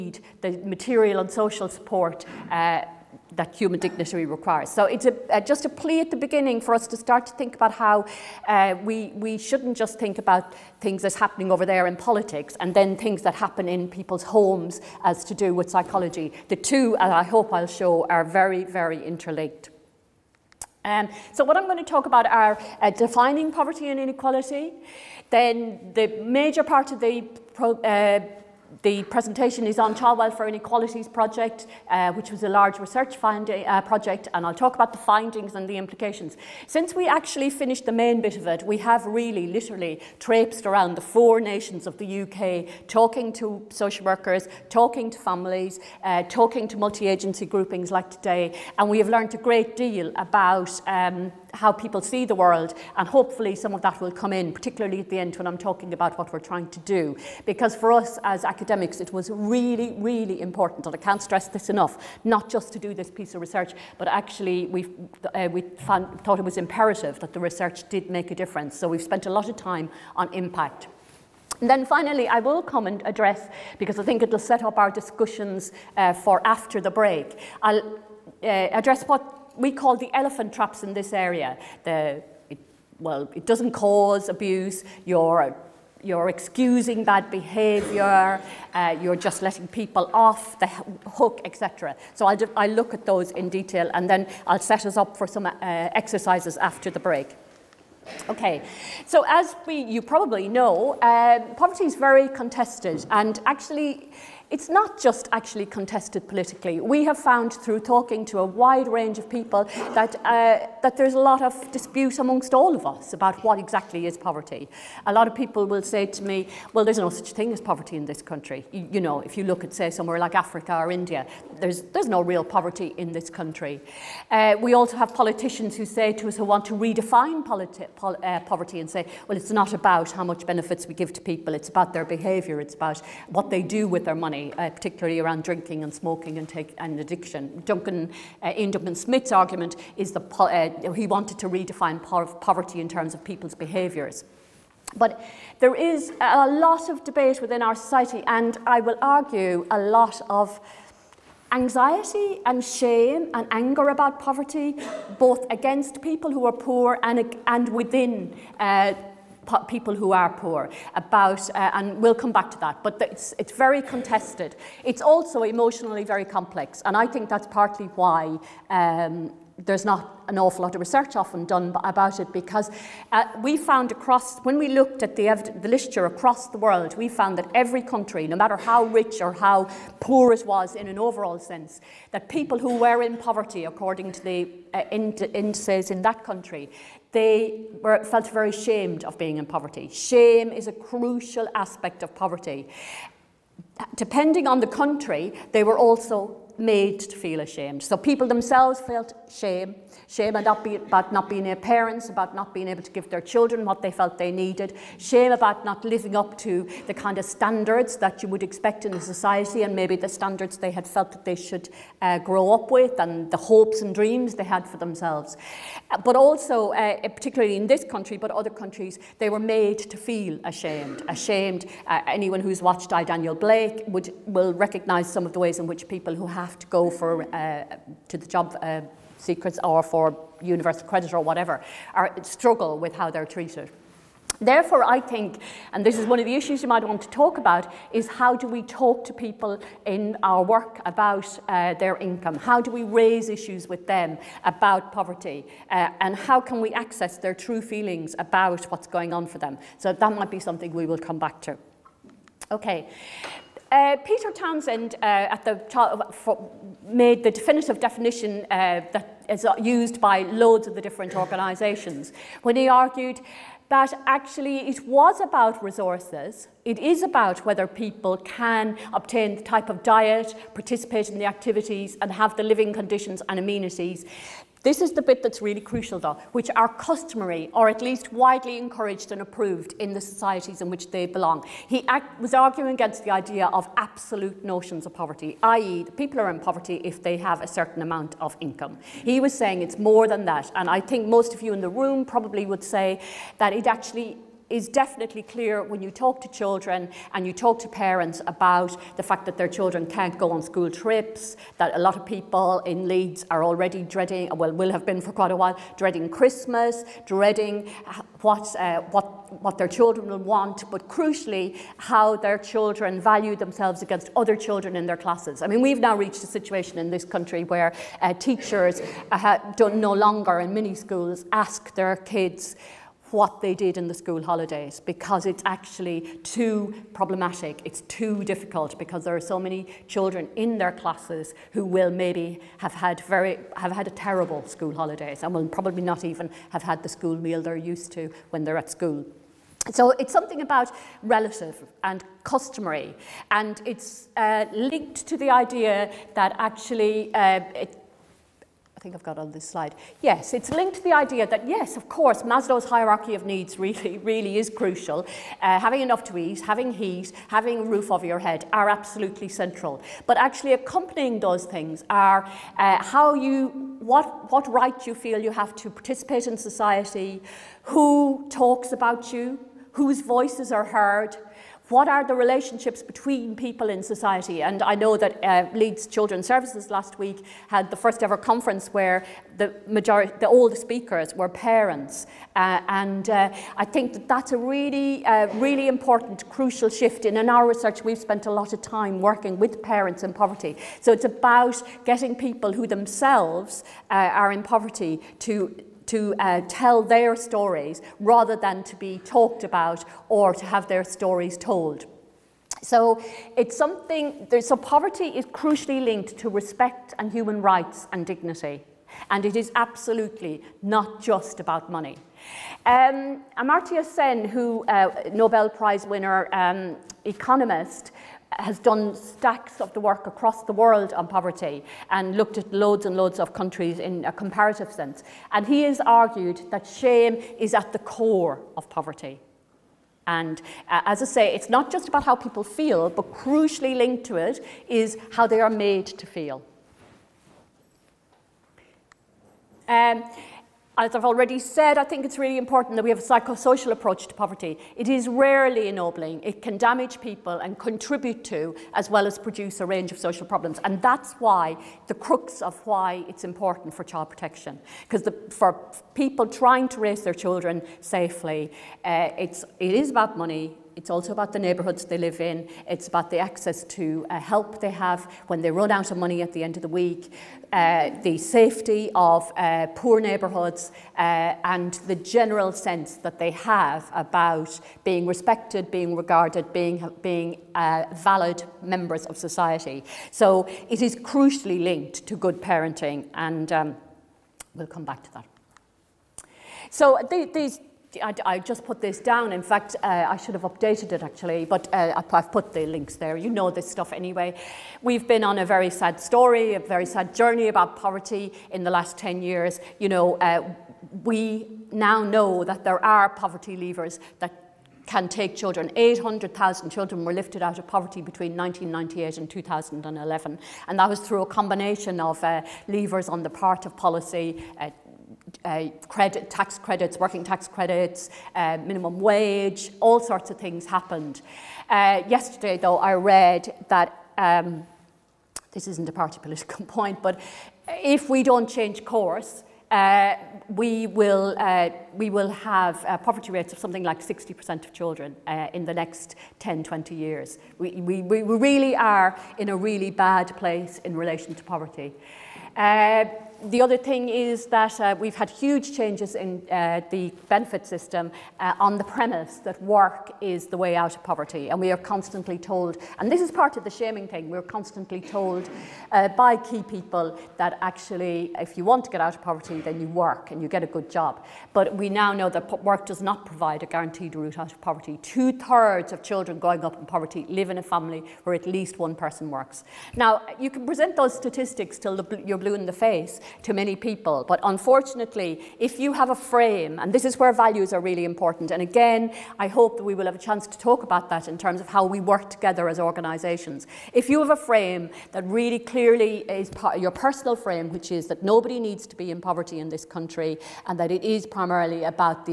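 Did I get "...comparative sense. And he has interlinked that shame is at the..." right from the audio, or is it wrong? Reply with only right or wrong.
wrong.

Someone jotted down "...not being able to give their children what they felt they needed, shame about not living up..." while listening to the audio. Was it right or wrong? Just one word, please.
right.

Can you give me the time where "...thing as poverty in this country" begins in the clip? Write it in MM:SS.
01:57.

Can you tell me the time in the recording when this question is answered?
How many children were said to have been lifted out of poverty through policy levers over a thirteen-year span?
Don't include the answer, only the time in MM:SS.
08:25.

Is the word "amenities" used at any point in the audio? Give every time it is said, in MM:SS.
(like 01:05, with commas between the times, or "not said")
04:33.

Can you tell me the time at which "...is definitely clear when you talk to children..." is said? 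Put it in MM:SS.
04:54.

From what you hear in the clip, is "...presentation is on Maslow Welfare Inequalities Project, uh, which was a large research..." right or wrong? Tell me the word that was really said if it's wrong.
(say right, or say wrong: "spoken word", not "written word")
wrong: "Child", not "Maslow".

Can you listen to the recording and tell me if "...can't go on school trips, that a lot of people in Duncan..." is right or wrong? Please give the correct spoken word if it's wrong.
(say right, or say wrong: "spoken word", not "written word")
wrong: "Leeds", not "Duncan".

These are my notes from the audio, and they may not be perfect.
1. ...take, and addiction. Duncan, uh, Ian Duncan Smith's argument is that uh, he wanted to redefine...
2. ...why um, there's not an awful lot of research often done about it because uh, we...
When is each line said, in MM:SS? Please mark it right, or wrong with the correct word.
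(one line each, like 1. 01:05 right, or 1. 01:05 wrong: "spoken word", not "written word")
1. 02:16 right
2. 02:47 right.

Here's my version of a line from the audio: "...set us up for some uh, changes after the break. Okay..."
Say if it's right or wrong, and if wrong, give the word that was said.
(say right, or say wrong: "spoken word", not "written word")
wrong: "exercises", not "changes".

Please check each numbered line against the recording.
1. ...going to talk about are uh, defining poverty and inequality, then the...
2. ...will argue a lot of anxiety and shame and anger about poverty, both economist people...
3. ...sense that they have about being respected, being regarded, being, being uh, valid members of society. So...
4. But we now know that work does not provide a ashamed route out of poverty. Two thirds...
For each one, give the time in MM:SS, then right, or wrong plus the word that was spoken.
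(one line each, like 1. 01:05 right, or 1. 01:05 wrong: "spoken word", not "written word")
1. 00:21 right
2. 02:28 wrong: "against", not "economist"
3. 07:52 right
4. 09:21 wrong: "guaranteed", not "ashamed".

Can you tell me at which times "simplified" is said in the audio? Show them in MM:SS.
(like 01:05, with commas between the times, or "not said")
not said.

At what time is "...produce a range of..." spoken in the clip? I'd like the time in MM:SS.
07:29.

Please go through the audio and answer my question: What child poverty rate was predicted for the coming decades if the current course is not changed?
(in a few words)
60%.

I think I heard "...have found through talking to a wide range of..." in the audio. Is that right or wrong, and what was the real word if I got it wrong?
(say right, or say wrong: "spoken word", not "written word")
right.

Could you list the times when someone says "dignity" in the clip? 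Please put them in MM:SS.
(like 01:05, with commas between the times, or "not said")
00:03, 06:48.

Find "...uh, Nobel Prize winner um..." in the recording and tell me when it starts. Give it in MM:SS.
06:54.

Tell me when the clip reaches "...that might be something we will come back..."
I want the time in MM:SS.
04:09.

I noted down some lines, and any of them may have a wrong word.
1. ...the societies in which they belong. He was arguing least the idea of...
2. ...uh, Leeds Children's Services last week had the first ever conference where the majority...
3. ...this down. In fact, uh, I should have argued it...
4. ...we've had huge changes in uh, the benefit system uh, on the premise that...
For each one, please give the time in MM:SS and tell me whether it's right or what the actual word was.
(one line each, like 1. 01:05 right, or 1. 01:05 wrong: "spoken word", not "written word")
1. 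04:39 wrong: "against", not "least"
2. 06:15 right
3. 08:08 wrong: "updated", not "argued"
4. 09:04 right.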